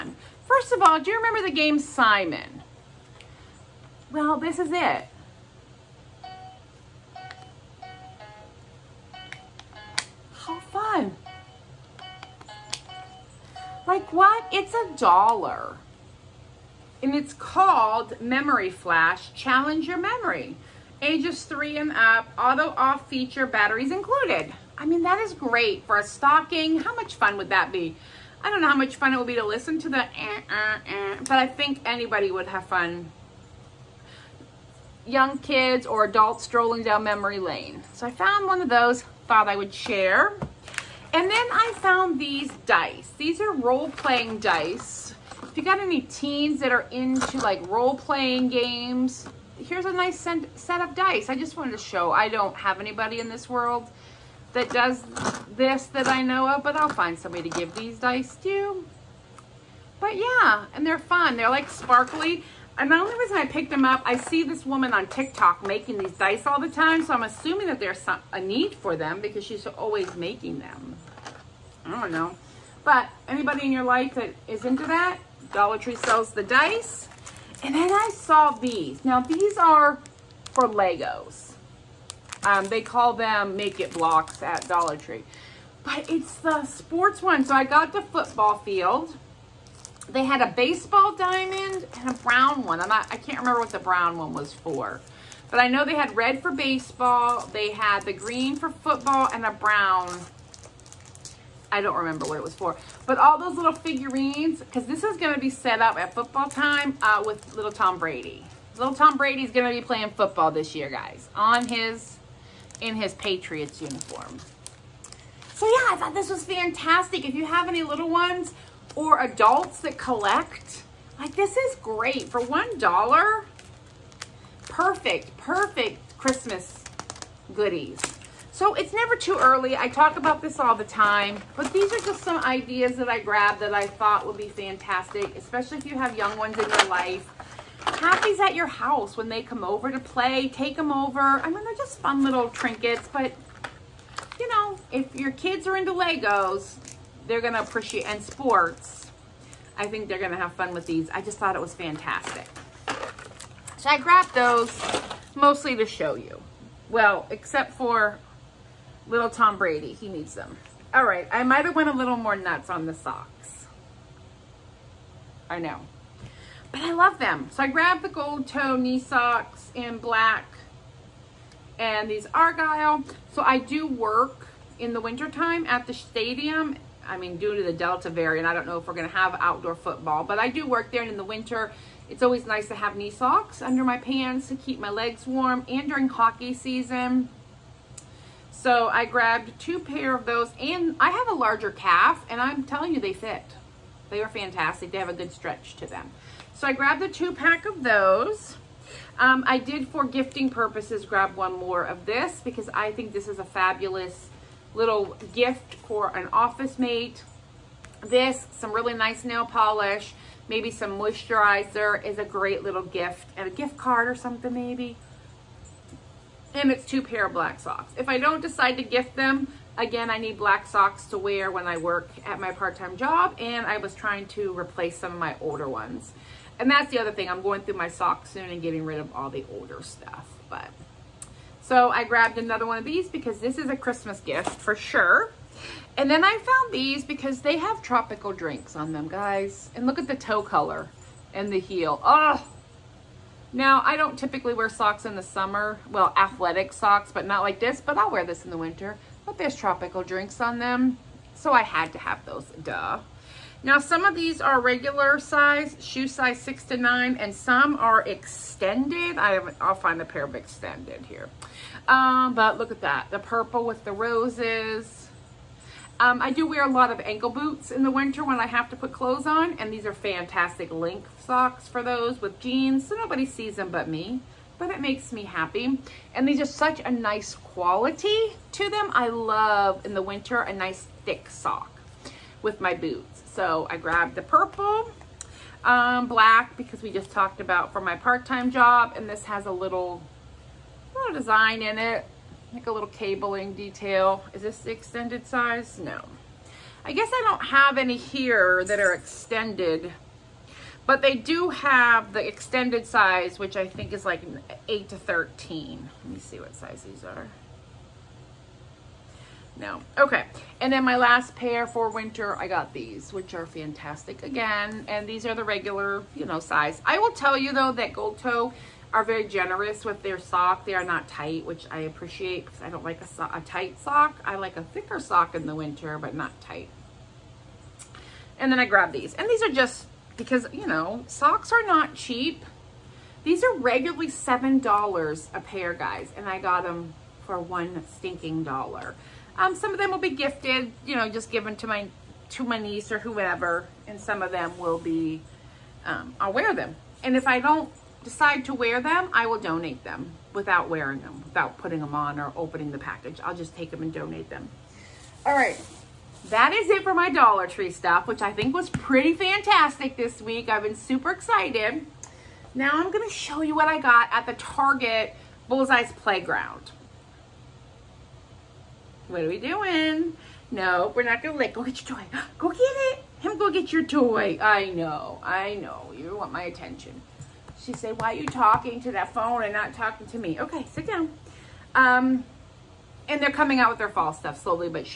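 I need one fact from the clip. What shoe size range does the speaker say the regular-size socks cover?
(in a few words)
6 to 9.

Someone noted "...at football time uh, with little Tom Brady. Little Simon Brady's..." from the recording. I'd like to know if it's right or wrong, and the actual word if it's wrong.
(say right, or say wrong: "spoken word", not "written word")
wrong: "Tom", not "Simon".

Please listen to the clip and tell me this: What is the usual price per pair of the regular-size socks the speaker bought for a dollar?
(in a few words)
$7.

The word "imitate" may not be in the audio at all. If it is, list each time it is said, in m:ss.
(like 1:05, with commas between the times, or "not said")
not said.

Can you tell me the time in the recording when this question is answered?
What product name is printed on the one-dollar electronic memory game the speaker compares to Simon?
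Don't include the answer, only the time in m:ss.
0:18.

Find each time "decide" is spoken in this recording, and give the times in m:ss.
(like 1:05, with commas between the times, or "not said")
3:38, 5:48.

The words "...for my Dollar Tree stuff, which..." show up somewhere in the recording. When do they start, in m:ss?
5:56.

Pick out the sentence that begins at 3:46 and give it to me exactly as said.
And that's the other thing, I'm going through my socks soon and getting rid of all the older stuff, but.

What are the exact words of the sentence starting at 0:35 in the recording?
Young kids or adults strolling down memory lane.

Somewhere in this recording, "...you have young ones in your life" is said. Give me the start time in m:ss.
2:15.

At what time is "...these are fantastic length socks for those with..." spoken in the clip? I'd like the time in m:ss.
4:29.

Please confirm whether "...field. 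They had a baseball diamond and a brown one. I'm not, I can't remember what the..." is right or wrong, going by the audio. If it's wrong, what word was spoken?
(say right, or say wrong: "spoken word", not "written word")
right.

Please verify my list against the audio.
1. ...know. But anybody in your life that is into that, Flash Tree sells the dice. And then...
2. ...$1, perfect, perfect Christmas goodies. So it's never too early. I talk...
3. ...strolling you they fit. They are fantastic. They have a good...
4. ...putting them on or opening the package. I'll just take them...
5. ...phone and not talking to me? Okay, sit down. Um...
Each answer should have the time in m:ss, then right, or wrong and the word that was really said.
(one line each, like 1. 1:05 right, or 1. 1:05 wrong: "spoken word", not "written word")
1. 1:12 wrong: "Dollar", not "Flash"
2. 2:02 right
3. 3:12 wrong: "telling", not "strolling"
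4. 5:51 right
5. 6:19 right.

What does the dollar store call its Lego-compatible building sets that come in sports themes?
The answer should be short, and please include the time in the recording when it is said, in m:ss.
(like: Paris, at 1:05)
make it blocks, at 1:23.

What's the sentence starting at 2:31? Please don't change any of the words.
I just thought it was fantastic.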